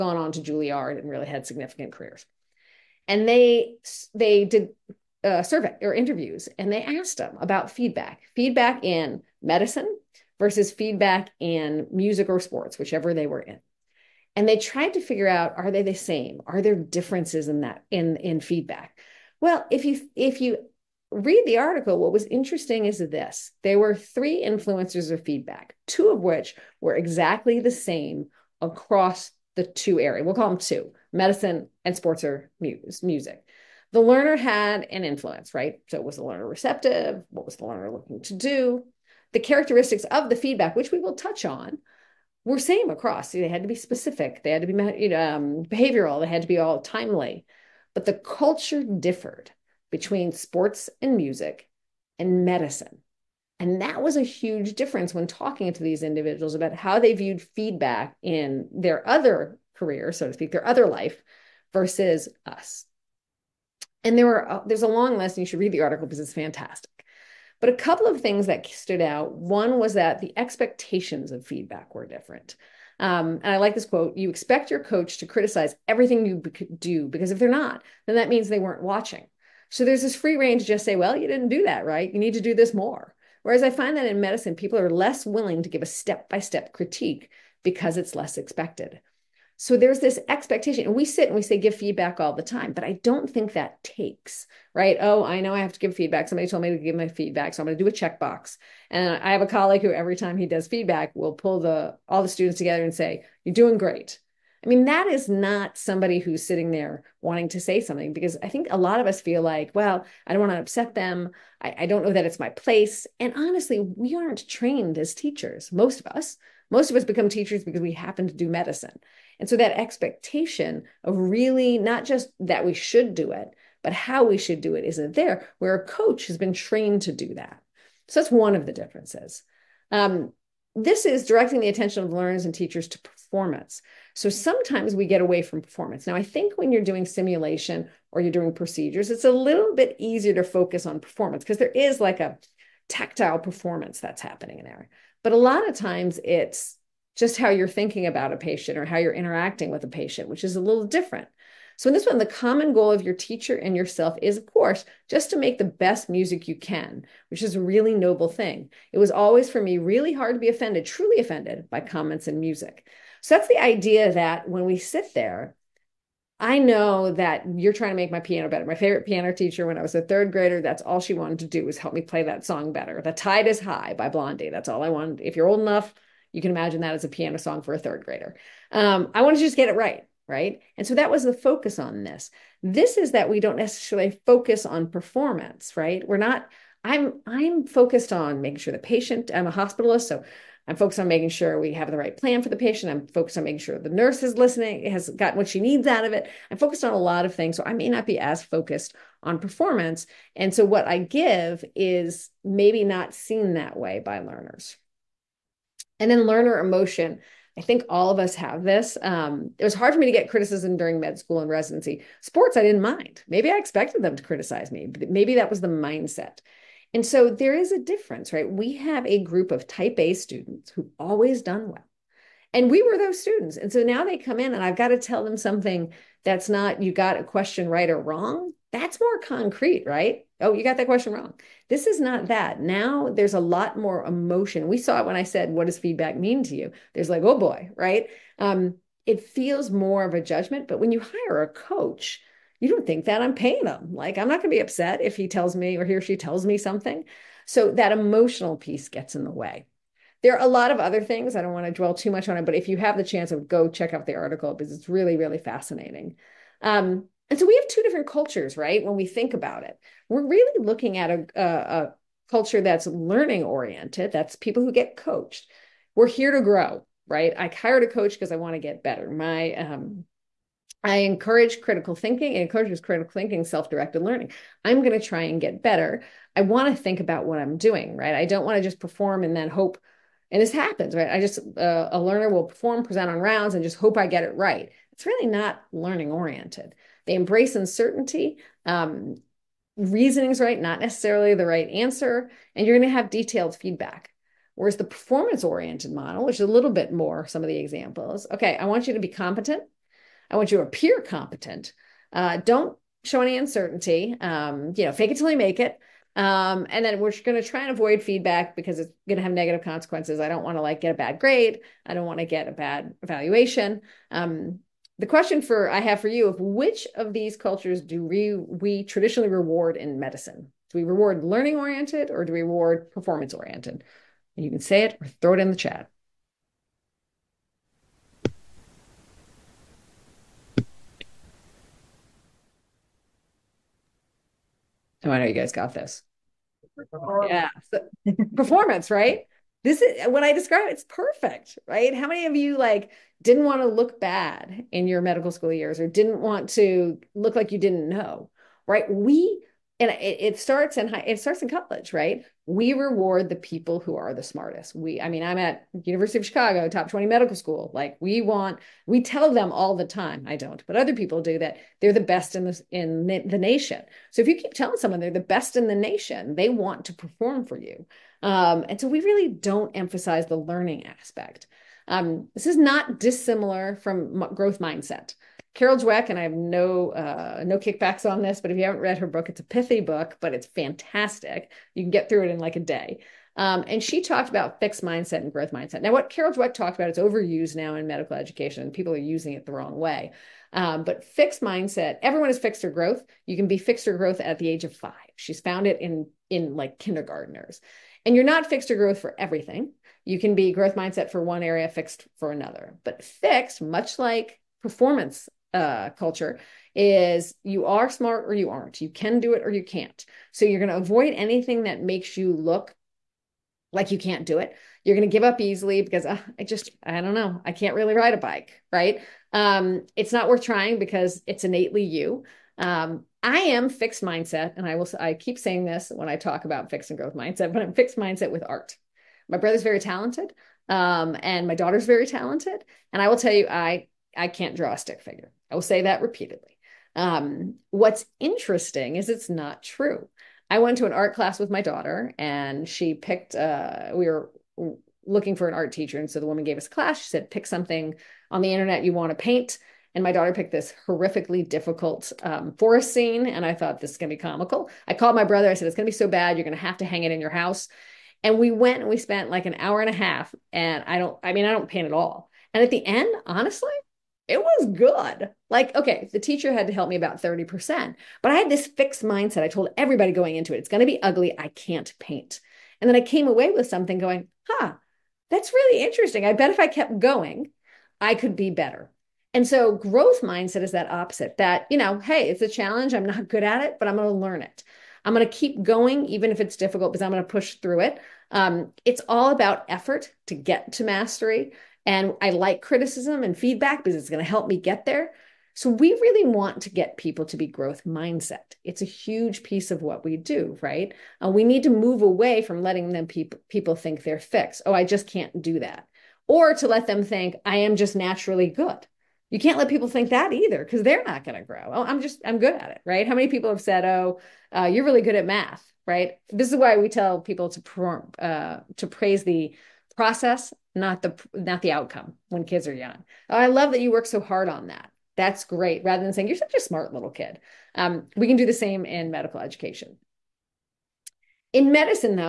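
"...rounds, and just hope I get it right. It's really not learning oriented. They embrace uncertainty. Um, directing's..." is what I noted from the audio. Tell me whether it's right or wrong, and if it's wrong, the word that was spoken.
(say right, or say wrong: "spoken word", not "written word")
wrong: "reasoning", not "directing".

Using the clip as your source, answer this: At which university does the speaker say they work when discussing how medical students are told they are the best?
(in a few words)
University of Chicago.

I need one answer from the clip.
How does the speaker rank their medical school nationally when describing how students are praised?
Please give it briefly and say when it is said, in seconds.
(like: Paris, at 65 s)
Top 20, at 356 s.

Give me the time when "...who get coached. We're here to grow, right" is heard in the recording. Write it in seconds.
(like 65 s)
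264 s.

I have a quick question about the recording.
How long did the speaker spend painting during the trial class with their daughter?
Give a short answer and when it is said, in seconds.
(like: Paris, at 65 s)
An hour and a half, at 459 s.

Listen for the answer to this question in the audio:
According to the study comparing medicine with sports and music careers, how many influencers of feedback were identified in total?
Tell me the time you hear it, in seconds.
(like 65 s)
23 s.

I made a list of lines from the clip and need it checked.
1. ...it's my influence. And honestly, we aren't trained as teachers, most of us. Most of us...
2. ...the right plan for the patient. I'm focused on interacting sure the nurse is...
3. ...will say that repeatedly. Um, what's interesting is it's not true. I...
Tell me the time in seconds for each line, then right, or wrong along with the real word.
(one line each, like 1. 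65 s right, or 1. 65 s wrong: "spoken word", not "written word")
1. 112 s wrong: "place", not "influence"
2. 191 s wrong: "making", not "interacting"
3. 435 s right.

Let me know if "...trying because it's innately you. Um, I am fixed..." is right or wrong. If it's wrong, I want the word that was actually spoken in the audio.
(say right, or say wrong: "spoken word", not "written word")
right.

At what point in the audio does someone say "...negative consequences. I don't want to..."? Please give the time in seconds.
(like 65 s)
309 s.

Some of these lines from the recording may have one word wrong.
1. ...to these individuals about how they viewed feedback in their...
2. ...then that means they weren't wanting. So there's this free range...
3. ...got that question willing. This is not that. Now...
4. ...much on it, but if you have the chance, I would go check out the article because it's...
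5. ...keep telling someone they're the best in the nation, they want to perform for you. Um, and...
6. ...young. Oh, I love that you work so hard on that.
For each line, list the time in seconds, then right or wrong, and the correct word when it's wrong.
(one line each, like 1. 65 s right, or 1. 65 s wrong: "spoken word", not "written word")
1. 55 s right
2. 78 s wrong: "watching", not "wanting"
3. 230 s wrong: "wrong", not "willing"
4. 252 s right
5. 364 s right
6. 522 s right.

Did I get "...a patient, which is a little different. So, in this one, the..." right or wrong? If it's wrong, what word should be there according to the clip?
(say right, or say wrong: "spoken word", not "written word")
right.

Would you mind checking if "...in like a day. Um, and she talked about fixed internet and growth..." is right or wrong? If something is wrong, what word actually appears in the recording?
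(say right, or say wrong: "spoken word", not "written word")
wrong: "mindset", not "internet".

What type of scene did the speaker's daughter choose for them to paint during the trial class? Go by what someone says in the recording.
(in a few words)
Forest scene.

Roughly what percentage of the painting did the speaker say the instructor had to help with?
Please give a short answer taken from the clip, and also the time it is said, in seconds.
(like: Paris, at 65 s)
30%, at 467 s.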